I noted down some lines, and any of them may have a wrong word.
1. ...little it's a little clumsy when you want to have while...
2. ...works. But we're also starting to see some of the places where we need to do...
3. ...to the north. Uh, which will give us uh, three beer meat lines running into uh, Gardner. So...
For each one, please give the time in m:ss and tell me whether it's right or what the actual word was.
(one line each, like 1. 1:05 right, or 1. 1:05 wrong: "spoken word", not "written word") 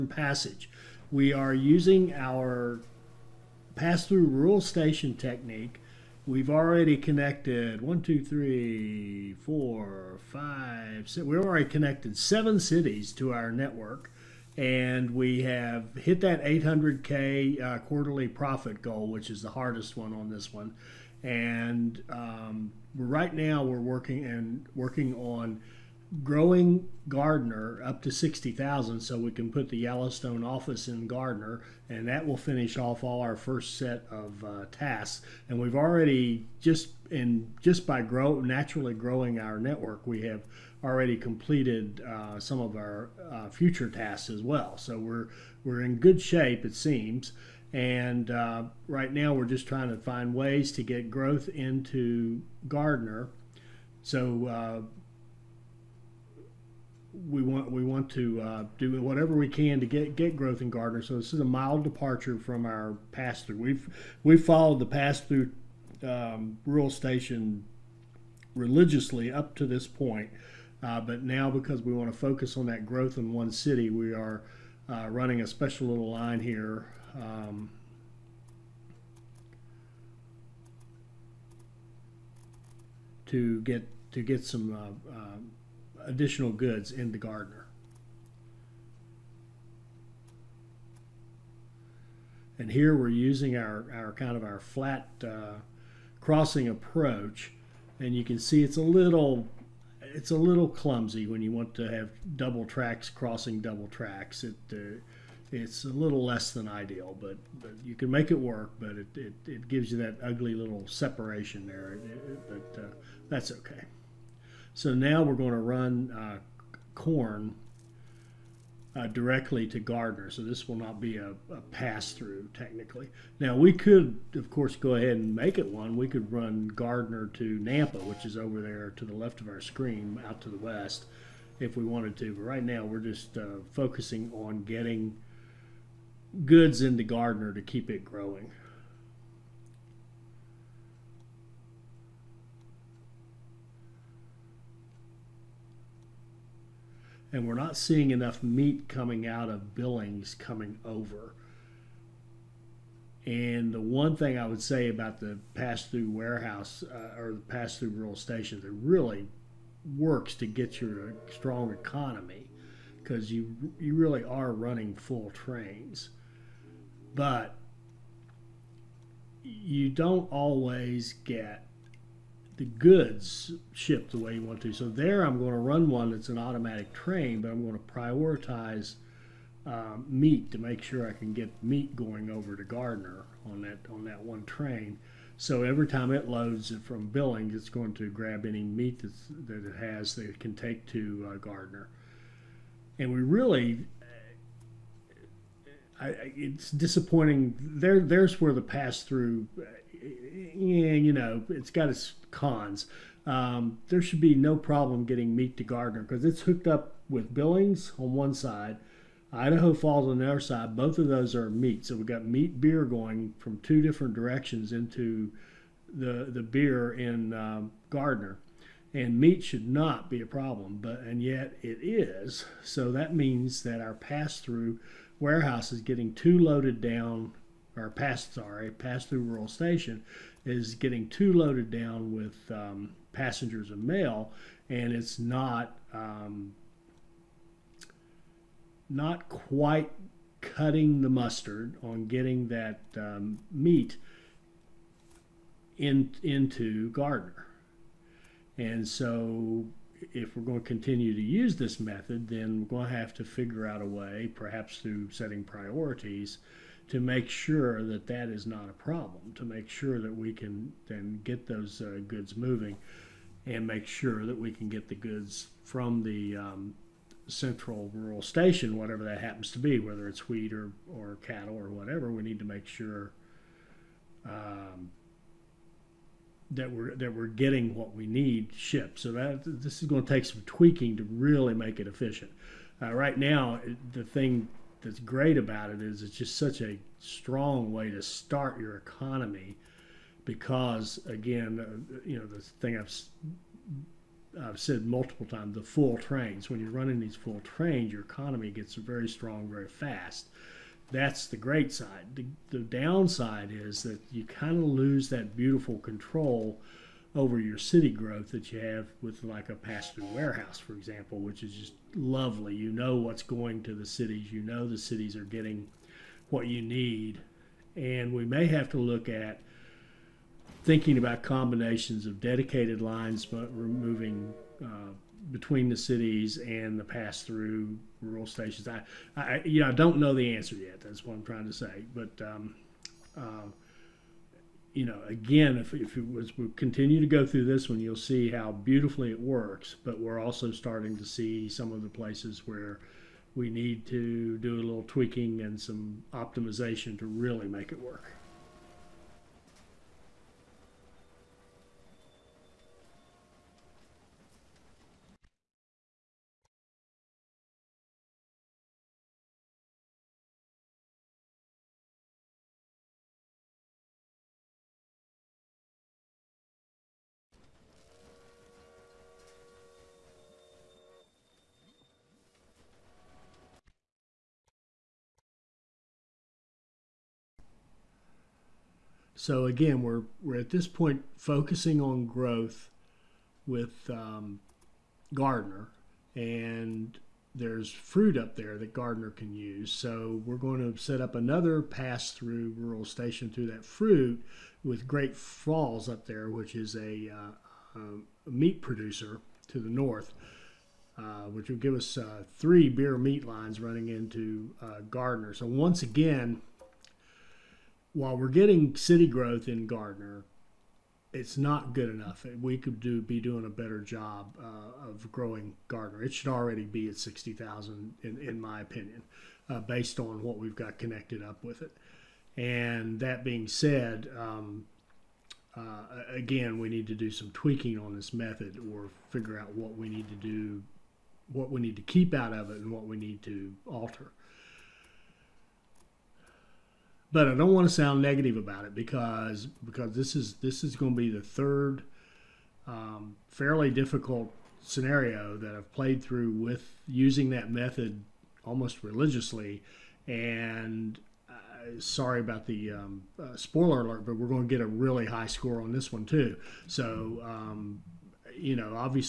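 1. 1:38 wrong: "double", not "while"
2. 5:39 right
3. 6:39 right.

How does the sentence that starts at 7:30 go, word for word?
And uh, sorry about the um, uh, spoiler alert, but we're going to get a really high score on this one too.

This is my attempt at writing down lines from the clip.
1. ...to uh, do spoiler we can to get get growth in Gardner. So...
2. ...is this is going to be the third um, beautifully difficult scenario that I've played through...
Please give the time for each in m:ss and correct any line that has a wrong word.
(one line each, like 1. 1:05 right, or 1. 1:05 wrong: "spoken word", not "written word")
1. 0:58 wrong: "whatever", not "spoiler"
2. 7:20 wrong: "fairly", not "beautifully".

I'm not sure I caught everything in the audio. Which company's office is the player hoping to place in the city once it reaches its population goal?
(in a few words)
Yellowstone.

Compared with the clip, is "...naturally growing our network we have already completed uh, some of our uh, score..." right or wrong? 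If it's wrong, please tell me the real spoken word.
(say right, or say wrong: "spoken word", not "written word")
wrong: "future", not "score".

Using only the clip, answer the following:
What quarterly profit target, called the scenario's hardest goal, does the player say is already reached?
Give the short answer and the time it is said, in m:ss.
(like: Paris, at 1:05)
800k, at 0:16.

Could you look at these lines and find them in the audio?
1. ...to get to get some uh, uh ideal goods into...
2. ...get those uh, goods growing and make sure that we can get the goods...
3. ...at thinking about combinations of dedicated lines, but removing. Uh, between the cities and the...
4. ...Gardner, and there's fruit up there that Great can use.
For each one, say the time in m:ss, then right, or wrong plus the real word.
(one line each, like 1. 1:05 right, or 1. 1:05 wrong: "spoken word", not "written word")
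1. 1:23 wrong: "additional", not "ideal"
2. 4:21 wrong: "moving", not "growing"
3. 5:19 right
4. 6:25 wrong: "Gardner", not "Great".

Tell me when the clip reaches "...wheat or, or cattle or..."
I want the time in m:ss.
4:30.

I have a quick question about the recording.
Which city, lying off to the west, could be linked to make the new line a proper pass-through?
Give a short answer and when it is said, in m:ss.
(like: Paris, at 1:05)
Nampa, at 2:07.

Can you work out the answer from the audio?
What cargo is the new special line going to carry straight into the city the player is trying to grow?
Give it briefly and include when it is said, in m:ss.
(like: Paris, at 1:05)
Corn, at 1:56.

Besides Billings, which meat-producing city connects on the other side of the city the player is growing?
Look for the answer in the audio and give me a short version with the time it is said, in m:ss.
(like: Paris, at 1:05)
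Idaho Falls, at 3:29.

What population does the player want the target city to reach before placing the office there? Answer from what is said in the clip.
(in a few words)
60,000.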